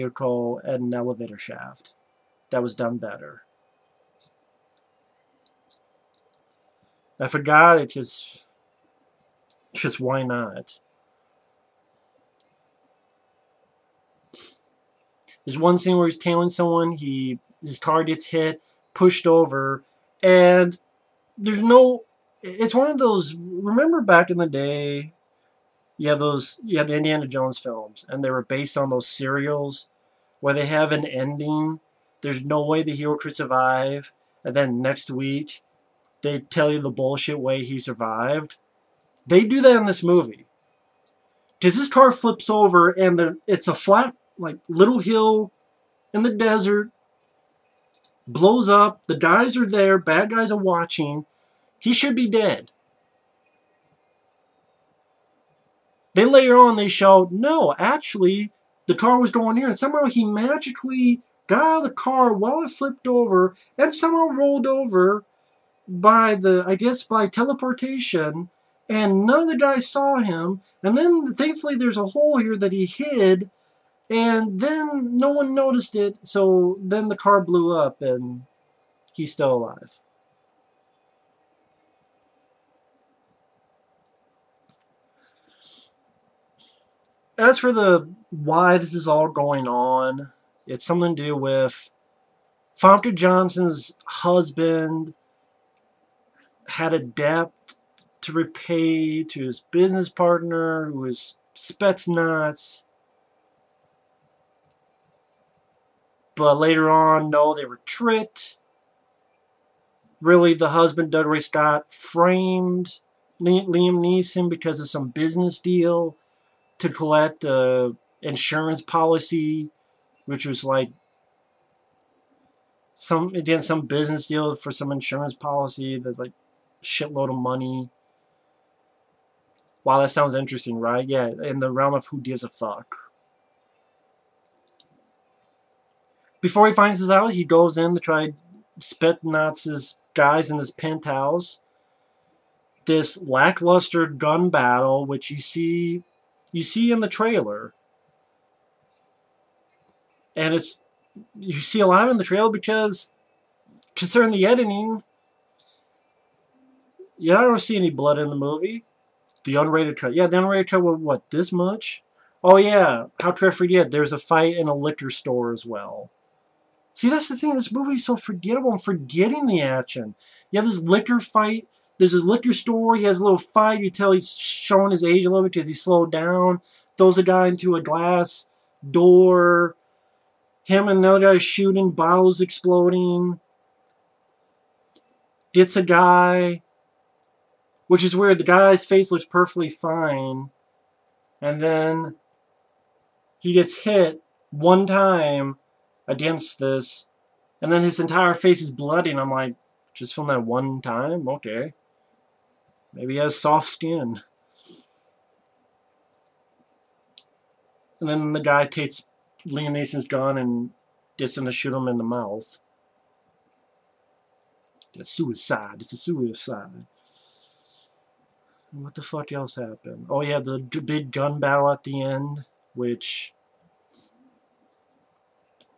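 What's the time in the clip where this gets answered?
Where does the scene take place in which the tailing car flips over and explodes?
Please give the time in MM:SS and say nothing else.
00:46.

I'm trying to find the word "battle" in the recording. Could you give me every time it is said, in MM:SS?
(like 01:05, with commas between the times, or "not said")
02:24, 03:41.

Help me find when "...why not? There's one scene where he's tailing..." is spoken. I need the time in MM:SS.
00:09.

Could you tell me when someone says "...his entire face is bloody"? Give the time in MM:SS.
03:17.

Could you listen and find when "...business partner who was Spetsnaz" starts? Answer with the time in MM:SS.
01:39.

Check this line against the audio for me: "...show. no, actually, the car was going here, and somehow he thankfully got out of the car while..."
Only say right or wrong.
wrong.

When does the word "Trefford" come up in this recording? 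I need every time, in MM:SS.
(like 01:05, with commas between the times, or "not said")
02:43.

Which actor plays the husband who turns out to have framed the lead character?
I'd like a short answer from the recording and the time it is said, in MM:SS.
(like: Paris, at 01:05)
Dougray Scott, at 01:51.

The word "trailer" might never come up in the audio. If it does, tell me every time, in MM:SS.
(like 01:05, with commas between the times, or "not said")
02:27, 02:32.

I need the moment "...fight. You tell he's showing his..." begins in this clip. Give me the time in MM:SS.
02:53.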